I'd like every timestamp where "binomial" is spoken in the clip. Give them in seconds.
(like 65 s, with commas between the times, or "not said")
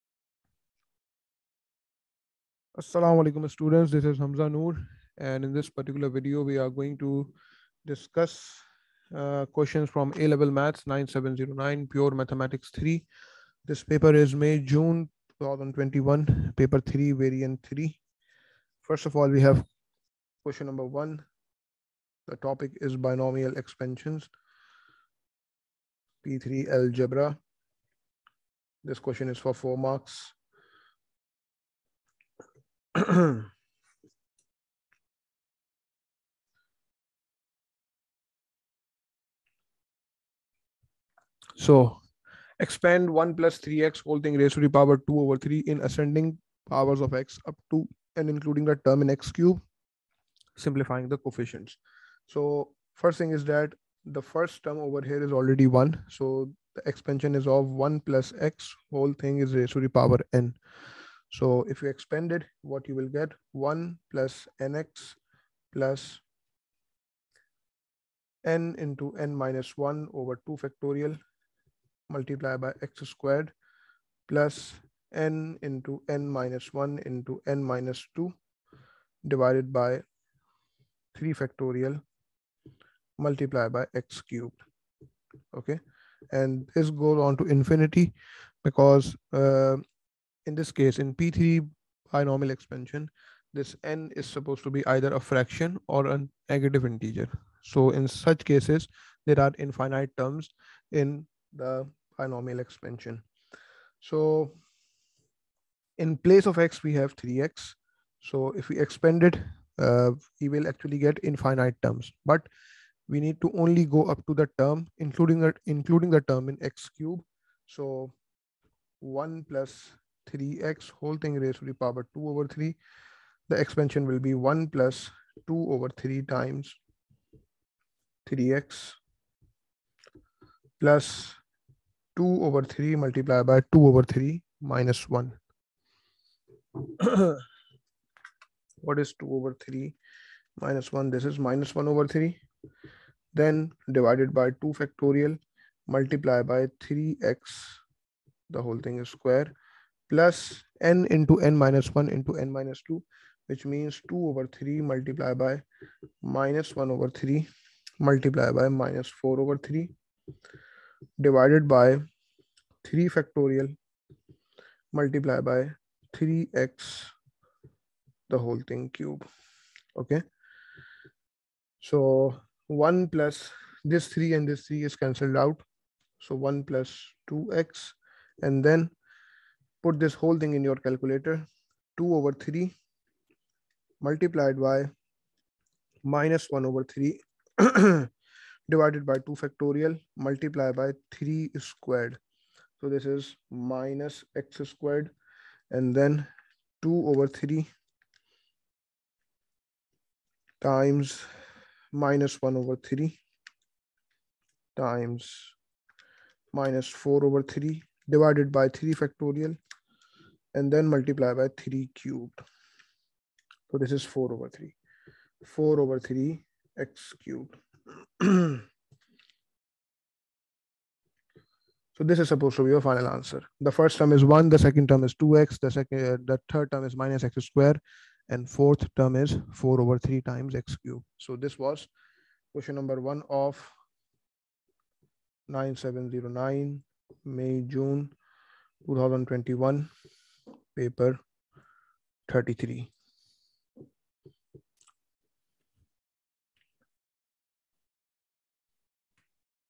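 22 s, 92 s, 102 s.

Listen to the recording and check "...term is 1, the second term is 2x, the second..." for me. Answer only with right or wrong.
right.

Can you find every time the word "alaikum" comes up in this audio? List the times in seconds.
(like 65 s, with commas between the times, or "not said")
3 s.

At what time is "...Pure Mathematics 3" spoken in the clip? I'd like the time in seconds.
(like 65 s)
11 s.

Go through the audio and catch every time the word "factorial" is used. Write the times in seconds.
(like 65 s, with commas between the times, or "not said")
70 s, 81 s, 144 s, 163 s, 189 s, 209 s.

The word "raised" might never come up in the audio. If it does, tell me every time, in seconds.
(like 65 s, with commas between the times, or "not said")
44 s, 59 s, 121 s.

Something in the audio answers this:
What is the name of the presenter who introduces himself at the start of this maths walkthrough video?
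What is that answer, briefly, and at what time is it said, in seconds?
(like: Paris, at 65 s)
Hamza Noor, at 4 s.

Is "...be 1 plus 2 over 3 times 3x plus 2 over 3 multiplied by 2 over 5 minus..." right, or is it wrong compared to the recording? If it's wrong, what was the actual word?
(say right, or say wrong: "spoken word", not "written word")
wrong: "3", not "5".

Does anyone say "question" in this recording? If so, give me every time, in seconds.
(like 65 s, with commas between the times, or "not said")
9 s, 20 s, 28 s, 232 s.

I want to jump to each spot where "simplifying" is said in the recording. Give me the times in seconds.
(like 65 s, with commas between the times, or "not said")
50 s.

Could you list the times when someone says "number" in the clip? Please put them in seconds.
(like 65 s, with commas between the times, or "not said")
20 s, 232 s.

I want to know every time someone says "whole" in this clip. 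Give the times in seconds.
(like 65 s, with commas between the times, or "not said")
44 s, 58 s, 120 s, 148 s, 168 s, 180 s.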